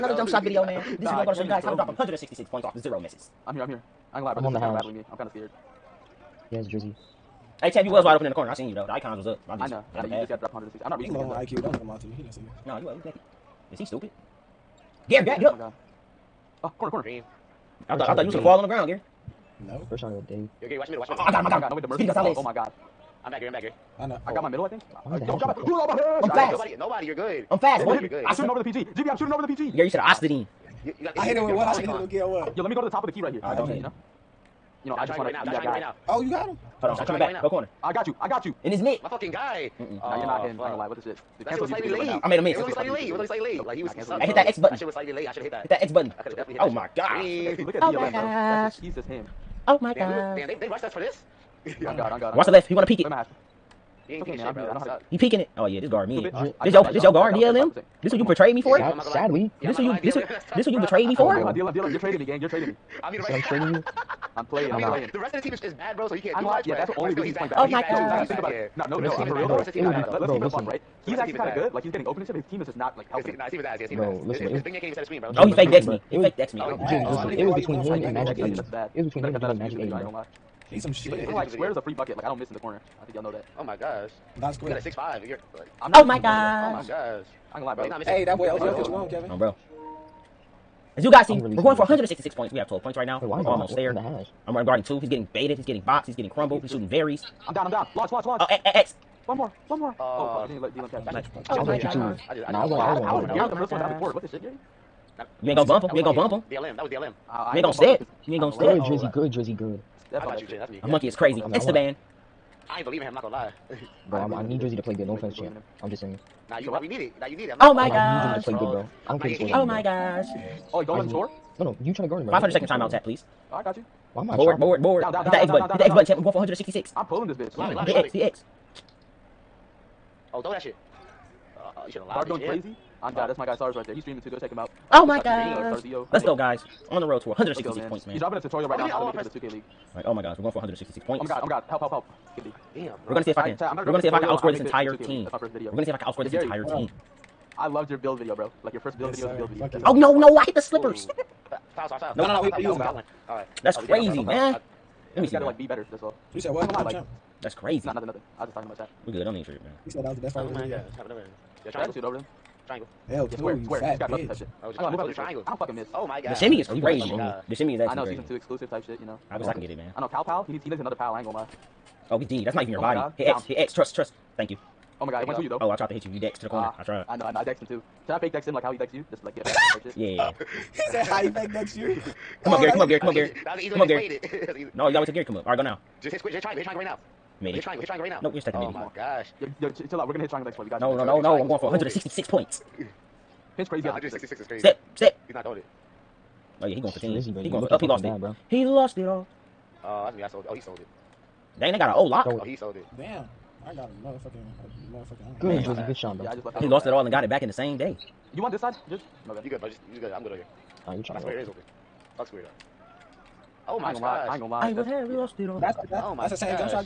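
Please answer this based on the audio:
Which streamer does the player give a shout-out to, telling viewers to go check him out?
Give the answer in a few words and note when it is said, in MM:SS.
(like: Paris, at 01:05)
SARS, at 02:13.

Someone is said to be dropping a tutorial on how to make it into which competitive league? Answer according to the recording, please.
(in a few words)
2K league.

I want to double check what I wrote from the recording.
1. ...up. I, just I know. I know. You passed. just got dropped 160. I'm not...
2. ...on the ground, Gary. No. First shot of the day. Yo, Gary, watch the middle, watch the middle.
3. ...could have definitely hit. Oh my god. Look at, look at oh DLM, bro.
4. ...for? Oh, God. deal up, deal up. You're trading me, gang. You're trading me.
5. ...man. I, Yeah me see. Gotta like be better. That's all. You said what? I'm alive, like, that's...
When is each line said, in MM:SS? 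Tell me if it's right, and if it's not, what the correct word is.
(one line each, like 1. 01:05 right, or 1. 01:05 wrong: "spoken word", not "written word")
1. 00:09 right
2. 00:18 right
3. 00:46 right
4. 01:01 right
5. 02:34 wrong: "Let", not "Yeah".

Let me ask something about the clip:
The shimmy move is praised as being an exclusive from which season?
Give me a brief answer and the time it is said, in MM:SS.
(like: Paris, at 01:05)
Season two, at 02:48.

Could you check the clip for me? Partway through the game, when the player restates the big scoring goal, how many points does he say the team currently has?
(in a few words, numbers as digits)
12.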